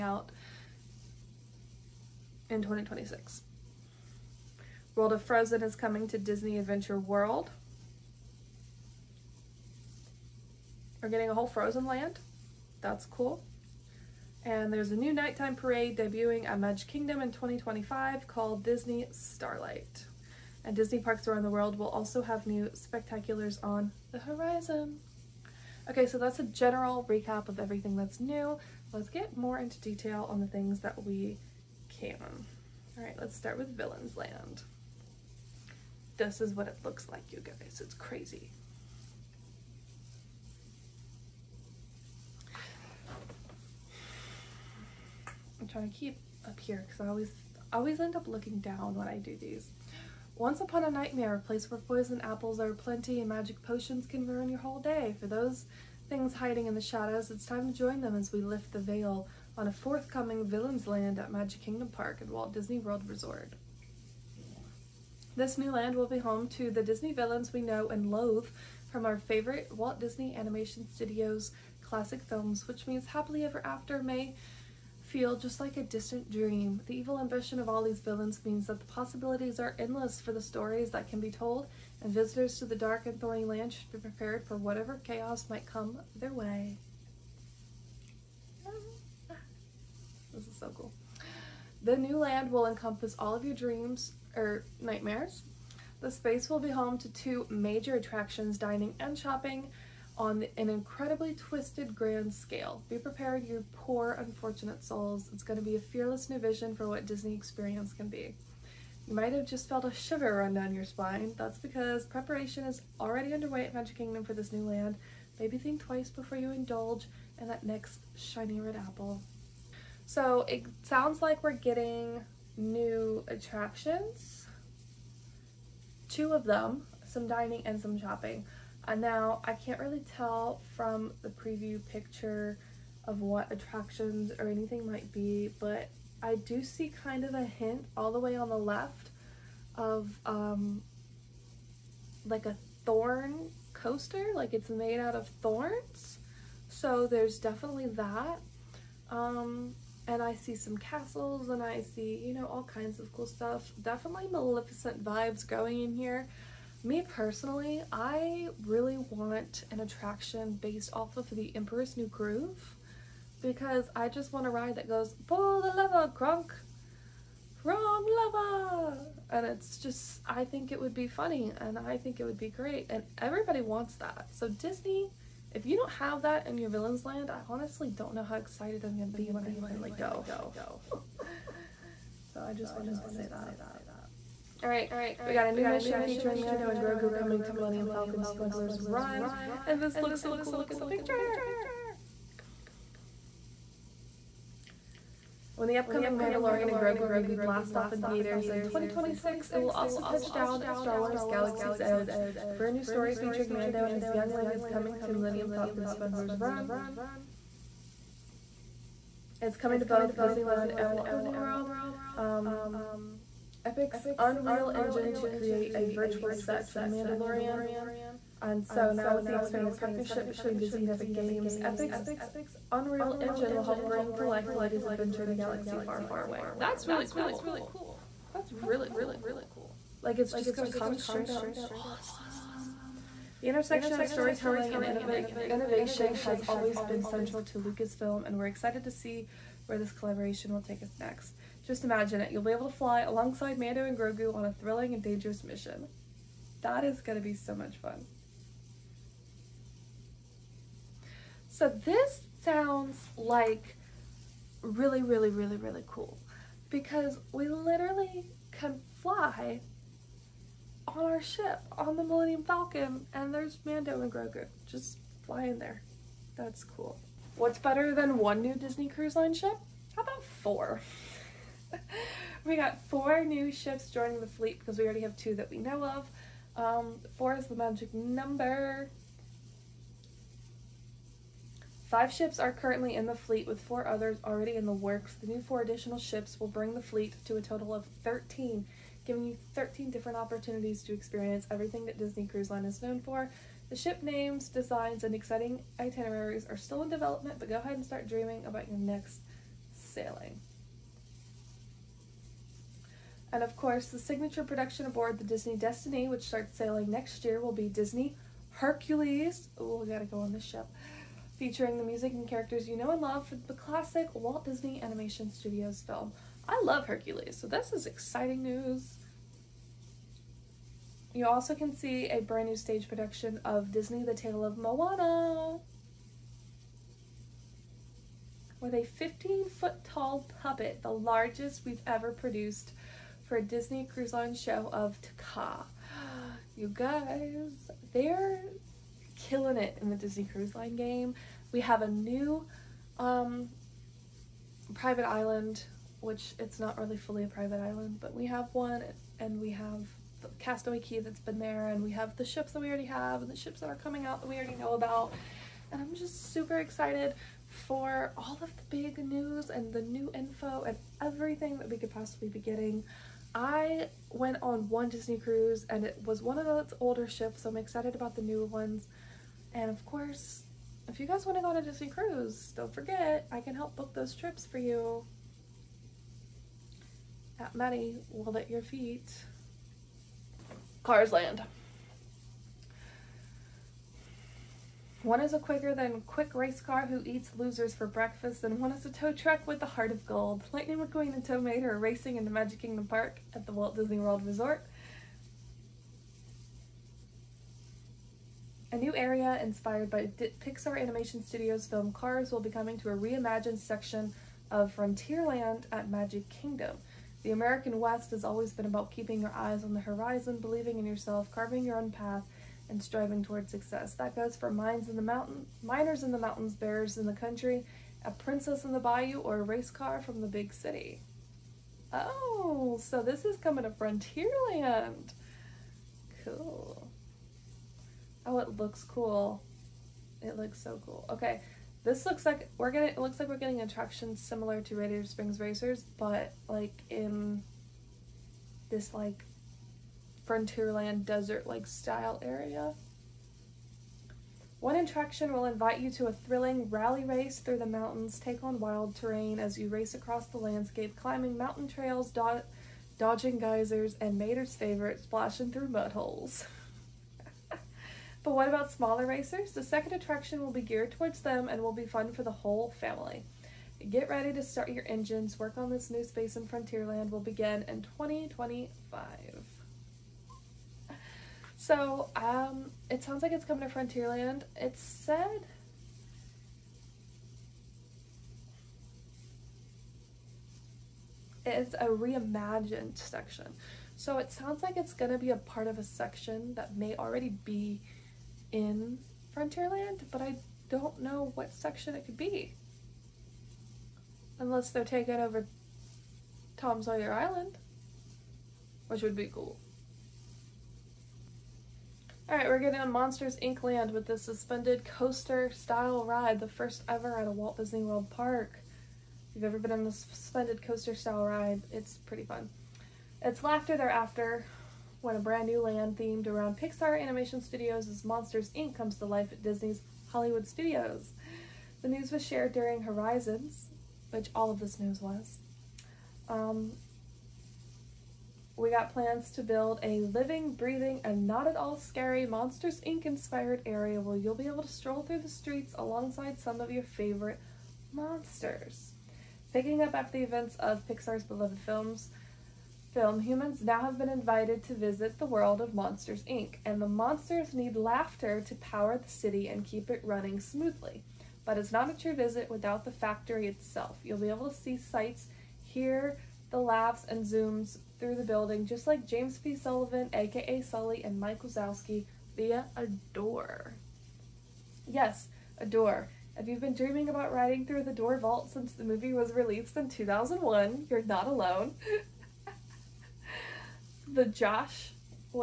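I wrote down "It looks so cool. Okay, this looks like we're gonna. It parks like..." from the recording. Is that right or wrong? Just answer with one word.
wrong.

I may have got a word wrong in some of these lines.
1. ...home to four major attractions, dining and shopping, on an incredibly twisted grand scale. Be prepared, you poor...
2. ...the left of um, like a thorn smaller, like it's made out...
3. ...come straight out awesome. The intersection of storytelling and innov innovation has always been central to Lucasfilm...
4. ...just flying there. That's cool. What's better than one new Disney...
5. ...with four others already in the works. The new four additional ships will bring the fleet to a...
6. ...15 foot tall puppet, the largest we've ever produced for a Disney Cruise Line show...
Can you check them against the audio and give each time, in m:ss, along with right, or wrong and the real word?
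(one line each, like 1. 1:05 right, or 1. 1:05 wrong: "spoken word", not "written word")
1. 1:36 wrong: "two", not "four"
2. 2:18 wrong: "coaster", not "smaller"
3. 3:50 right
4. 4:24 right
5. 4:43 right
6. 5:28 right.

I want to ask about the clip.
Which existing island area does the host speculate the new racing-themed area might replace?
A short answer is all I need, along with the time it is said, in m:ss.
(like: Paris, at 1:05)
Tom Sawyer Island, at 8:16.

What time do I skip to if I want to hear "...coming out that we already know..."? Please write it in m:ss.
5:53.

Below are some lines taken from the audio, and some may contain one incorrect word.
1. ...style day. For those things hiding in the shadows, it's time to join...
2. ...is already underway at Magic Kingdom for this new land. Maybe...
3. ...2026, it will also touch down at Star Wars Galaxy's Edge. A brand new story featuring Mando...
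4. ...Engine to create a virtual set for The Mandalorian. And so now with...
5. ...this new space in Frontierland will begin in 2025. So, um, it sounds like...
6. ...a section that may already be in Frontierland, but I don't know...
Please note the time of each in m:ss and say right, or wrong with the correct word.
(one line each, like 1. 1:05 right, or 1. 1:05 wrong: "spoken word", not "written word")
1. 0:54 wrong: "whole", not "style"
2. 1:52 right
3. 3:18 right
4. 3:34 right
5. 7:45 right
6. 8:05 right.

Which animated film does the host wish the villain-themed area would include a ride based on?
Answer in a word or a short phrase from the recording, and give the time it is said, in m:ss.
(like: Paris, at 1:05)
The Emperor's New Groove, at 2:41.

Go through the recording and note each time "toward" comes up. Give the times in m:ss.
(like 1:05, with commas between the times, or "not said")
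6:53, 7:40.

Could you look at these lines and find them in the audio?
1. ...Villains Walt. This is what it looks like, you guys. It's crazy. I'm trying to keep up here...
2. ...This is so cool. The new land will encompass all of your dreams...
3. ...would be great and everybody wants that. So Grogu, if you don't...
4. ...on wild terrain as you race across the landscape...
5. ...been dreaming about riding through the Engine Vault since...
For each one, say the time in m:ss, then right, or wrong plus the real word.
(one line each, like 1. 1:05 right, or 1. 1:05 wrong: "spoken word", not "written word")
1. 0:33 wrong: "Land", not "Walt"
2. 1:30 right
3. 2:52 wrong: "Disney", not "Grogu"
4. 7:28 right
5. 9:26 wrong: "Door", not "Engine".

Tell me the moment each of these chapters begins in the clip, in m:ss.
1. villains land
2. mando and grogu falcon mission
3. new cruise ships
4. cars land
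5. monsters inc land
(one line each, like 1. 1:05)
1. 0:33
2. 3:04
3. 4:27
4. 6:21
5. 8:21.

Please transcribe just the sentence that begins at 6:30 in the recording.
Lightning McQueen and Tow Mater are racing in the Magic Kingdom Park at the Walt Disney World Resort.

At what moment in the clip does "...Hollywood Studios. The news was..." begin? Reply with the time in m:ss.
8:40.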